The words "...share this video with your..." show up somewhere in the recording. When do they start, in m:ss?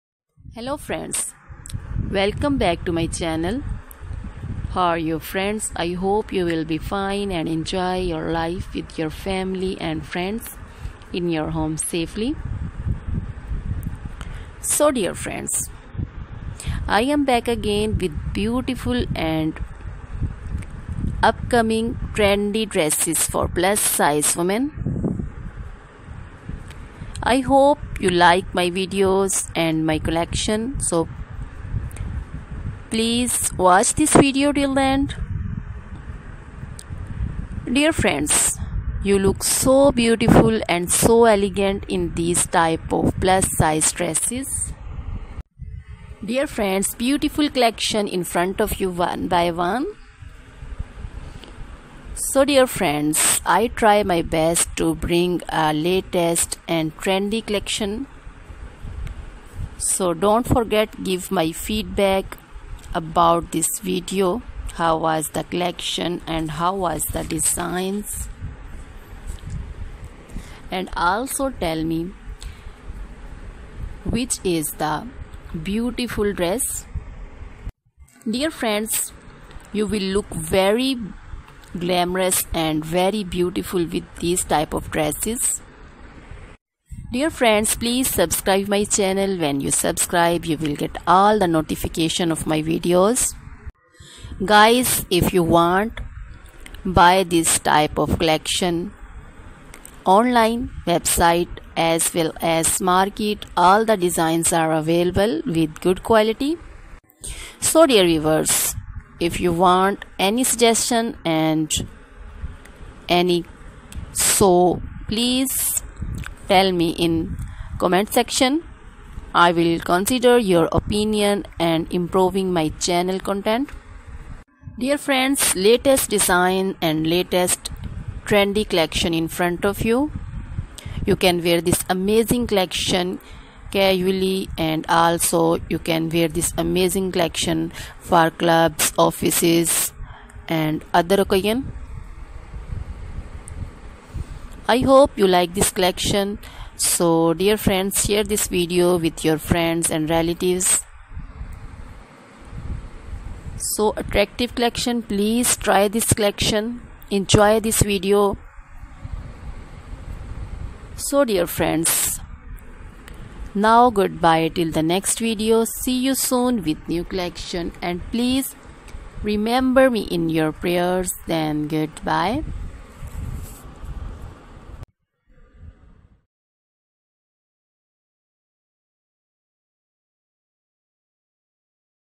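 2:28.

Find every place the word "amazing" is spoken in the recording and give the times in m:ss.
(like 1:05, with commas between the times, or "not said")
2:11, 2:16.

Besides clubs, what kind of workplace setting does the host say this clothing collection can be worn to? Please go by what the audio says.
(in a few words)
offices.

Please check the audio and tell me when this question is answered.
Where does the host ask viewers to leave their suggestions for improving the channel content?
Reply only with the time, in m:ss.
1:57.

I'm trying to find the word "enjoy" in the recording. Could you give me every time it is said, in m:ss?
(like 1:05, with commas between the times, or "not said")
0:07, 2:37.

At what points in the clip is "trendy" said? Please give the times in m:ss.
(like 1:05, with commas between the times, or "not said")
0:22, 0:56, 2:08.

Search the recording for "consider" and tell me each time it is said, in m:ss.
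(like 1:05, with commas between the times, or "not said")
1:59.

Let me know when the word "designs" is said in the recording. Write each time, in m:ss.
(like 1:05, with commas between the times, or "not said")
1:07, 1:43, 2:06.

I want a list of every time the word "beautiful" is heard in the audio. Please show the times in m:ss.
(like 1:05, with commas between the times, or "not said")
0:18, 0:39, 0:46, 1:15, 1:23.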